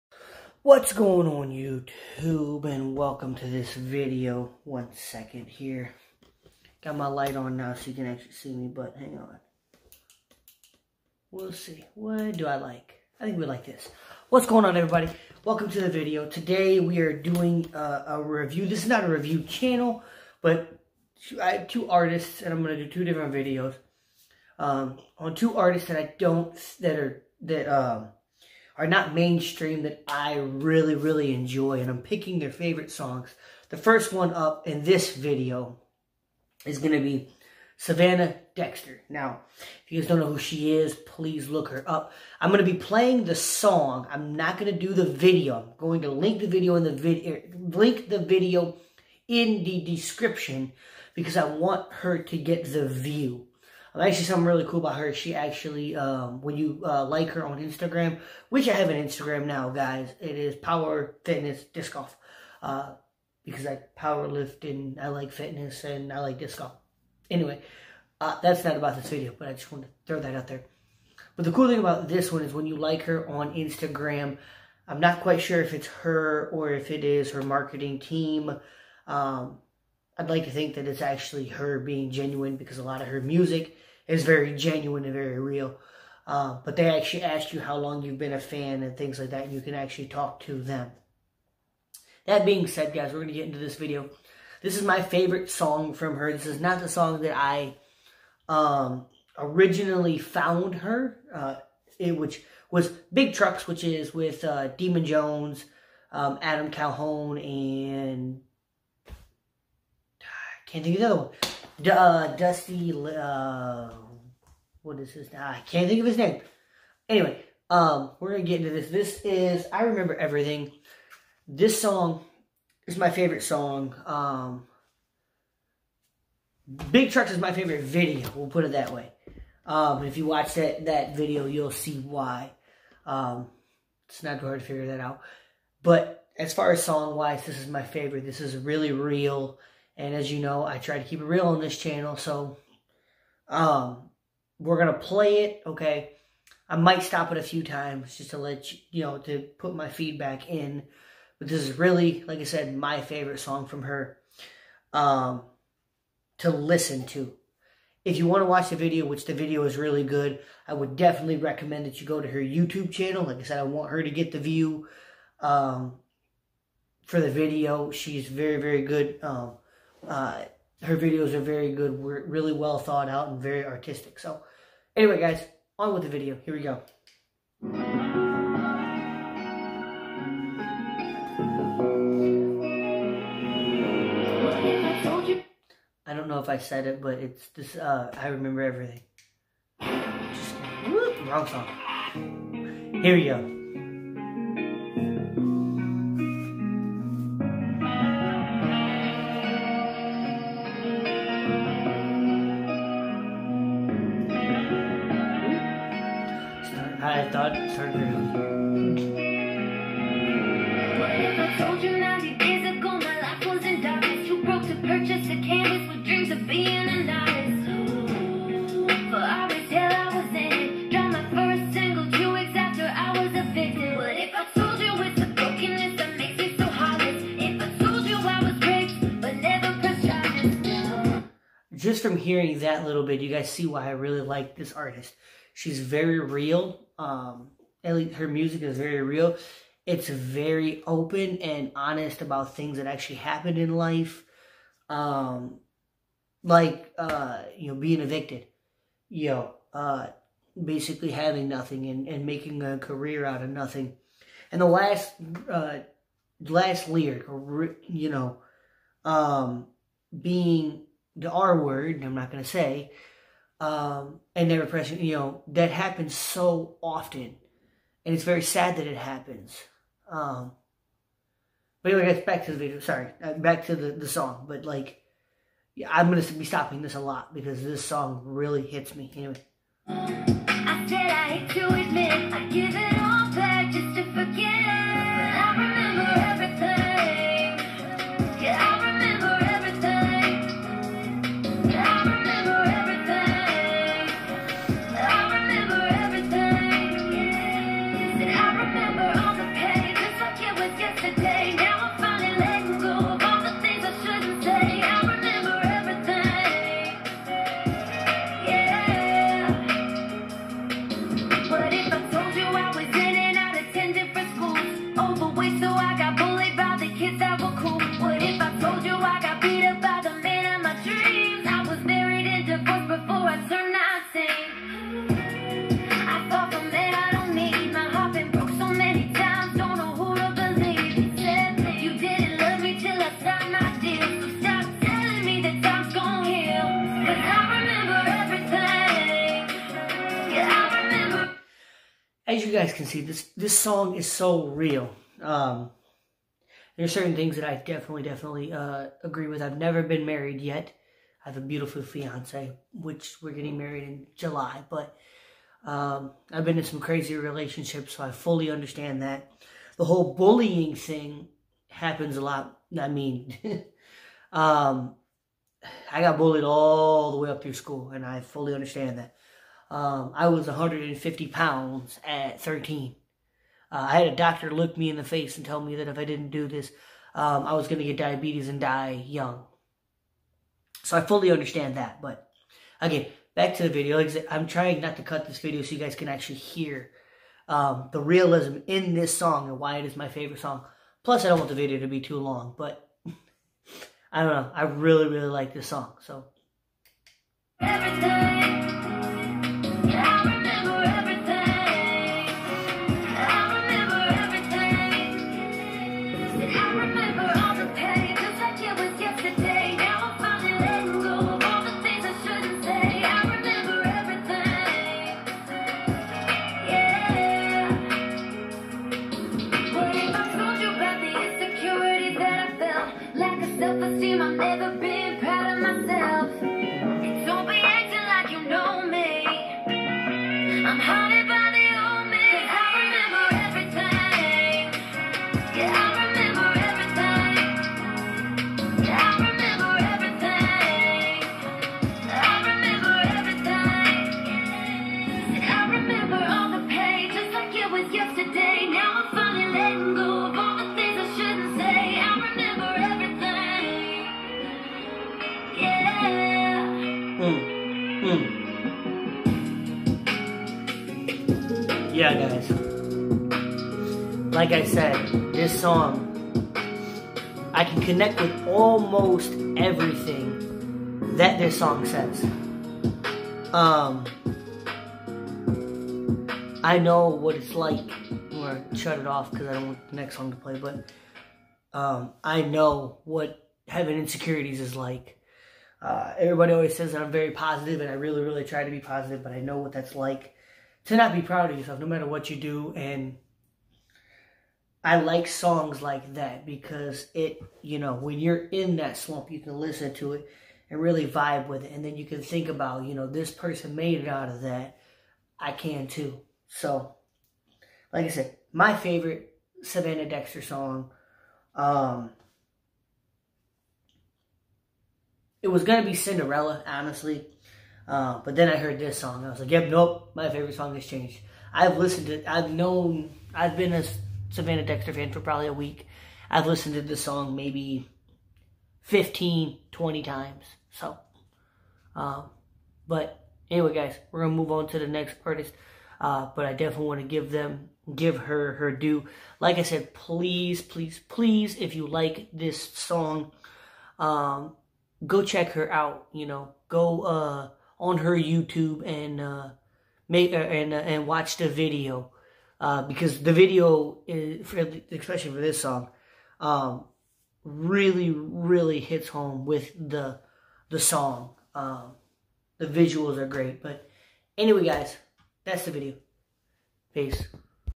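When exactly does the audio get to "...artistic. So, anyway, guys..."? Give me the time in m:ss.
2:53.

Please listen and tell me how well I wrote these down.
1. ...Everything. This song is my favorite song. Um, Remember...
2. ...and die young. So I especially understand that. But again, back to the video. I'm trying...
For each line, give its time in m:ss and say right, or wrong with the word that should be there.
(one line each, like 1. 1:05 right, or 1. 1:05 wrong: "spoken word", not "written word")
1. 2:00 wrong: "Big", not "Remember"
2. 6:18 wrong: "fully", not "especially".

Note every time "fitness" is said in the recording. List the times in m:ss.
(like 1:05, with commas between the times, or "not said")
1:01, 1:05.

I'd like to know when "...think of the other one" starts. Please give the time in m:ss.
1:50.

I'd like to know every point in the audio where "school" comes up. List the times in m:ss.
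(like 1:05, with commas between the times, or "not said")
6:07.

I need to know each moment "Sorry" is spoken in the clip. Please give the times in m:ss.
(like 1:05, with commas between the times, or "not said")
4:32.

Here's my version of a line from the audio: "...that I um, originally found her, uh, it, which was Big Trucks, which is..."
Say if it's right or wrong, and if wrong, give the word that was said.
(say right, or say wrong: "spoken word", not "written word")
right.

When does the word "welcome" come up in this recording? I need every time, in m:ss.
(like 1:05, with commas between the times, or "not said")
0:02, 0:15.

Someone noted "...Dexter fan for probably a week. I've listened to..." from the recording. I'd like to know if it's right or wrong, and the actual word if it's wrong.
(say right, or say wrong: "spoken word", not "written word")
right.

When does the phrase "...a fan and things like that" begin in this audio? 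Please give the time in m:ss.
1:28.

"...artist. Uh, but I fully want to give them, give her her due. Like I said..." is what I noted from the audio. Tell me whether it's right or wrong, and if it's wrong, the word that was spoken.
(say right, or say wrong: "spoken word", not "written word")
wrong: "definitely", not "fully".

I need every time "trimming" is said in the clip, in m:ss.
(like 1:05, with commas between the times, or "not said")
not said.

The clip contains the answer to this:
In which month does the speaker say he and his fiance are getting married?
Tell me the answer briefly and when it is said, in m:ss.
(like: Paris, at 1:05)
July, at 5:54.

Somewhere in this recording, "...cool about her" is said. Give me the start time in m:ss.
0:54.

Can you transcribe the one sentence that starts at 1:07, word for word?
Anyway, uh, that's not about this video, but I just wanted to throw that out there.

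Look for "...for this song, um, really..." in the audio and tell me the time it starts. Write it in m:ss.
9:15.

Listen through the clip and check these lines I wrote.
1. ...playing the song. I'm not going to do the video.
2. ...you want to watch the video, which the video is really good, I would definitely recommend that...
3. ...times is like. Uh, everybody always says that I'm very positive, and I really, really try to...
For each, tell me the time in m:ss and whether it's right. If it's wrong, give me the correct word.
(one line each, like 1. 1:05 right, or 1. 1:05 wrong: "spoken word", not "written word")
1. 0:42 right
2. 2:38 right
3. 8:03 wrong: "insecurities", not "times".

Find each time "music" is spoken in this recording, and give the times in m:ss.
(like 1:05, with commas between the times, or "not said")
1:23, 3:58.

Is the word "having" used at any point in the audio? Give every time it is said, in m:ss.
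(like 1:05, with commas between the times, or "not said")
4:11, 8:03.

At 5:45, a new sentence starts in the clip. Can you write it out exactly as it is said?
Um, there's certain things that I definitely, definitely uh, agree with.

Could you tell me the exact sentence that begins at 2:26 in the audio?
I might stop it a few times just to let you, you know, to put my feedback in.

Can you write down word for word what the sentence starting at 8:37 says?
Uh, but then I heard this song.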